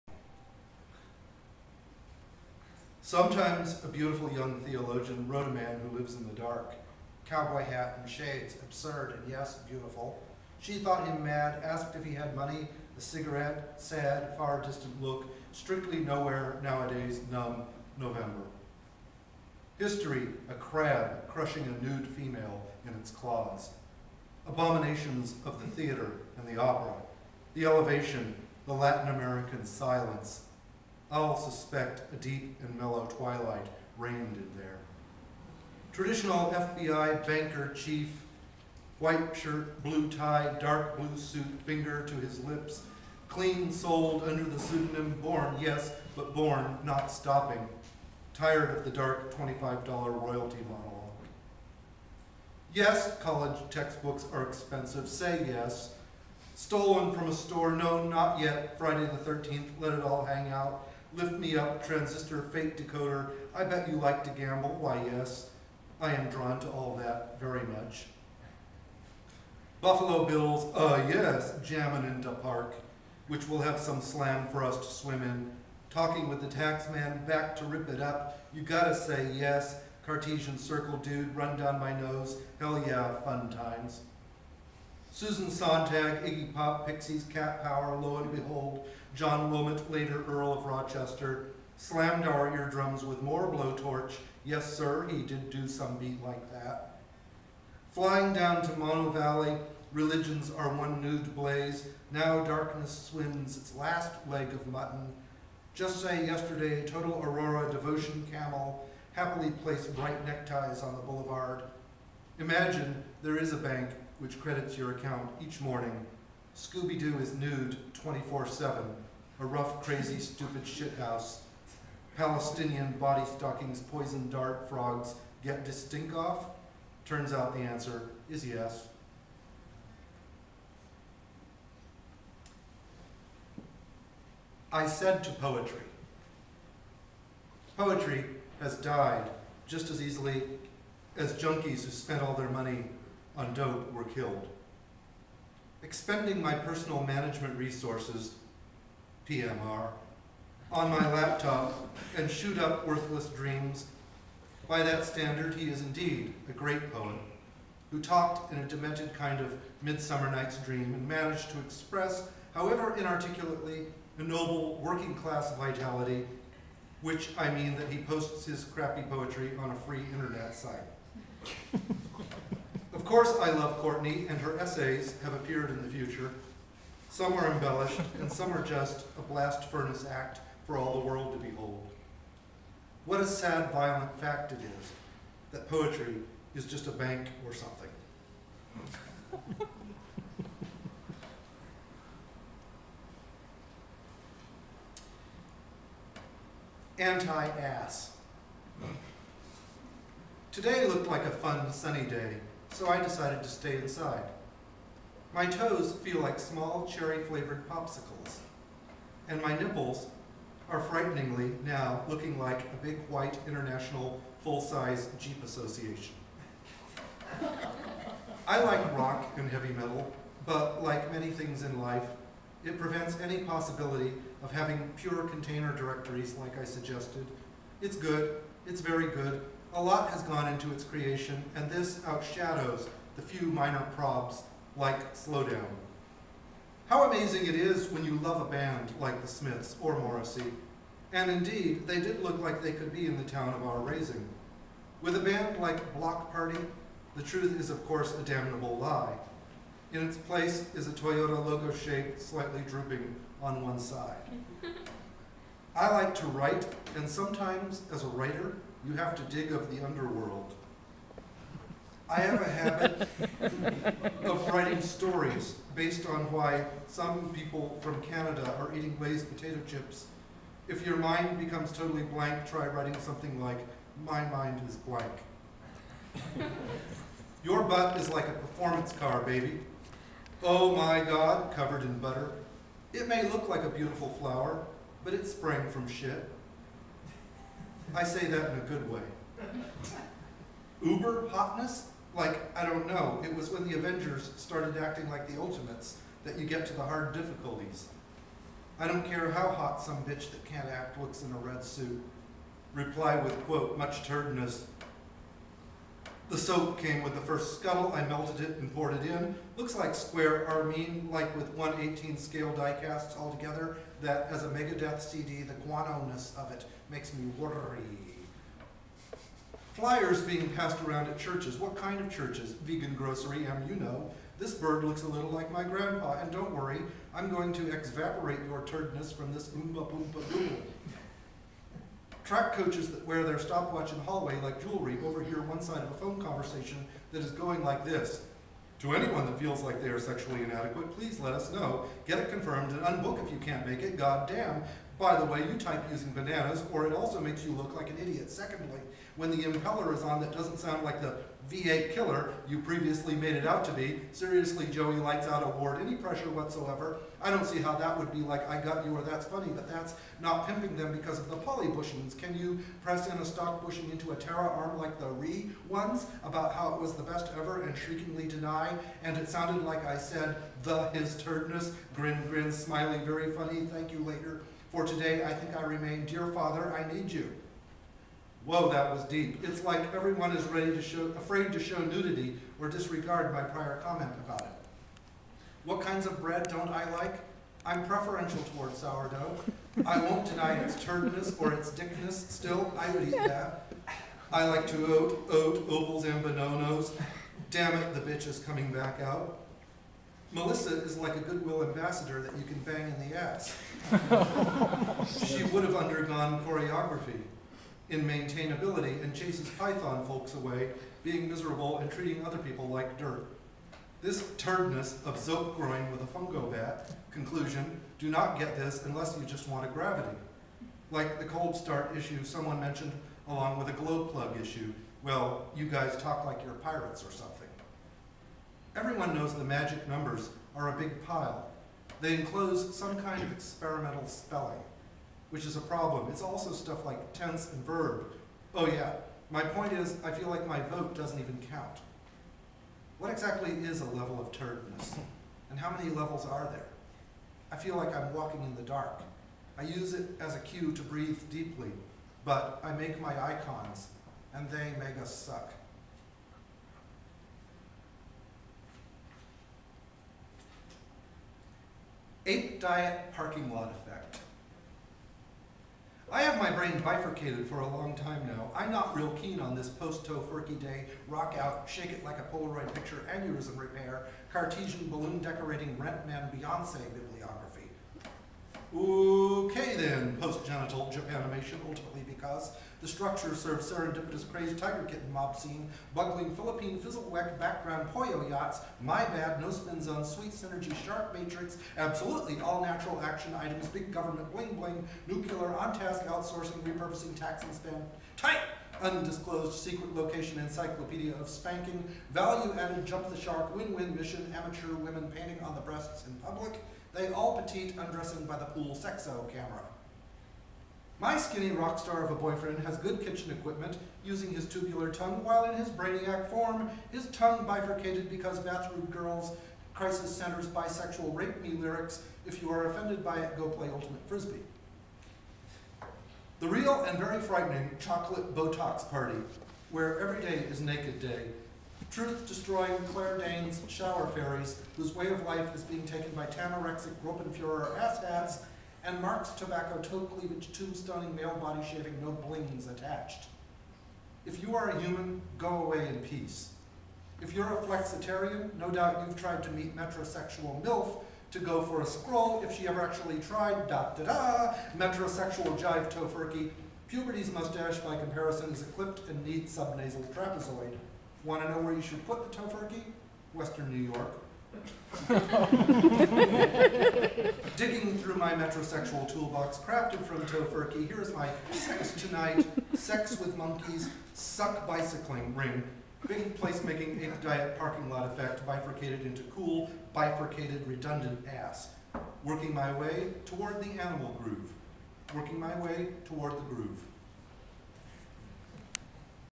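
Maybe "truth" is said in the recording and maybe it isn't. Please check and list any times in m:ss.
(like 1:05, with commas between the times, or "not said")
4:07, 8:51.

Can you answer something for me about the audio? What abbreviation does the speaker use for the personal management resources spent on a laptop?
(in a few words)
PMR.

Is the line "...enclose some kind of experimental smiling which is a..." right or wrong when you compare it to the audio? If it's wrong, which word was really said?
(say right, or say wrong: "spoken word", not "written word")
wrong: "spelling", not "smiling".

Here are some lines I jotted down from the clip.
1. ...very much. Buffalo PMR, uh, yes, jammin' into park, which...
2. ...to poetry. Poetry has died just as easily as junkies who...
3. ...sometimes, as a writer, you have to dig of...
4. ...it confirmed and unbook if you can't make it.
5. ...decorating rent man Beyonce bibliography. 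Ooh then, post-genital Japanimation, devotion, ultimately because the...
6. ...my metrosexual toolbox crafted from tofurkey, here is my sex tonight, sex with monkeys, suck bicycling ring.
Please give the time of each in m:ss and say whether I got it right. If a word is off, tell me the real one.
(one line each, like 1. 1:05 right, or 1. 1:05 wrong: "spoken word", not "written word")
1. 1:07 wrong: "Bills", not "PMR"
2. 2:15 right
3. 4:17 right
4. 5:42 right
5. 7:55 wrong: "animation", not "devotion"
6. 9:28 right.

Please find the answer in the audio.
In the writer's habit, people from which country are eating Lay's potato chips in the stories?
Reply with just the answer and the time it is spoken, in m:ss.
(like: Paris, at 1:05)
Canada, at 4:28.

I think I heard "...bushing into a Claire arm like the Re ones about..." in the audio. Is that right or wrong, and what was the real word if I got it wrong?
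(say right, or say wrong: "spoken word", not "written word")
wrong: "Terra", not "Claire".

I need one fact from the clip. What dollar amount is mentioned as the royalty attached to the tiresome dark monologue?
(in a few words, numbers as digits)
$25.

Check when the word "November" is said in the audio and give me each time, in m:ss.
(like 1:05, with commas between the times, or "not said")
0:17.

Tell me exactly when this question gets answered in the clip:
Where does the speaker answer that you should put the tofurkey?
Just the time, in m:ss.
9:23.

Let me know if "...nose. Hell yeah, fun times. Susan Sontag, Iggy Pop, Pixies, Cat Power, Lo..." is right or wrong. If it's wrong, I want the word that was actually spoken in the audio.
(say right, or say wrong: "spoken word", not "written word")
right.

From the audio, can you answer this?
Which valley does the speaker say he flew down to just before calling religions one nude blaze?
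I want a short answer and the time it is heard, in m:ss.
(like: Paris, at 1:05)
Mono Valley, at 1:38.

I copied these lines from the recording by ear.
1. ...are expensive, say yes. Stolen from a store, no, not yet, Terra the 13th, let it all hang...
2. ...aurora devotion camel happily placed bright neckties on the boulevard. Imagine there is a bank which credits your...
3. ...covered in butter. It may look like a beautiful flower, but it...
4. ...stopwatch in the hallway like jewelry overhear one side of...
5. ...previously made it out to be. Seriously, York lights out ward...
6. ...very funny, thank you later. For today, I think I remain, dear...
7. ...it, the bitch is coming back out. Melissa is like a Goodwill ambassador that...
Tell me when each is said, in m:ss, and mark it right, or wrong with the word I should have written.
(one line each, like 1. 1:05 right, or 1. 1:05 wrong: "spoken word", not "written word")
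1. 0:54 wrong: "Friday", not "Terra"
2. 1:47 right
3. 4:41 right
4. 5:33 right
5. 5:52 wrong: "Joey", not "York"
6. 6:13 right
7. 6:37 right.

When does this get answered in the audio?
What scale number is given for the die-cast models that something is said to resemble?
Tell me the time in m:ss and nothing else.
5:11.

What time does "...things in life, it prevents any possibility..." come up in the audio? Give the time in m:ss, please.
3:41.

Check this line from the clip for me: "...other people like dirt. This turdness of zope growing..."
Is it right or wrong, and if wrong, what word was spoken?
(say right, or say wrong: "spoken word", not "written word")
right.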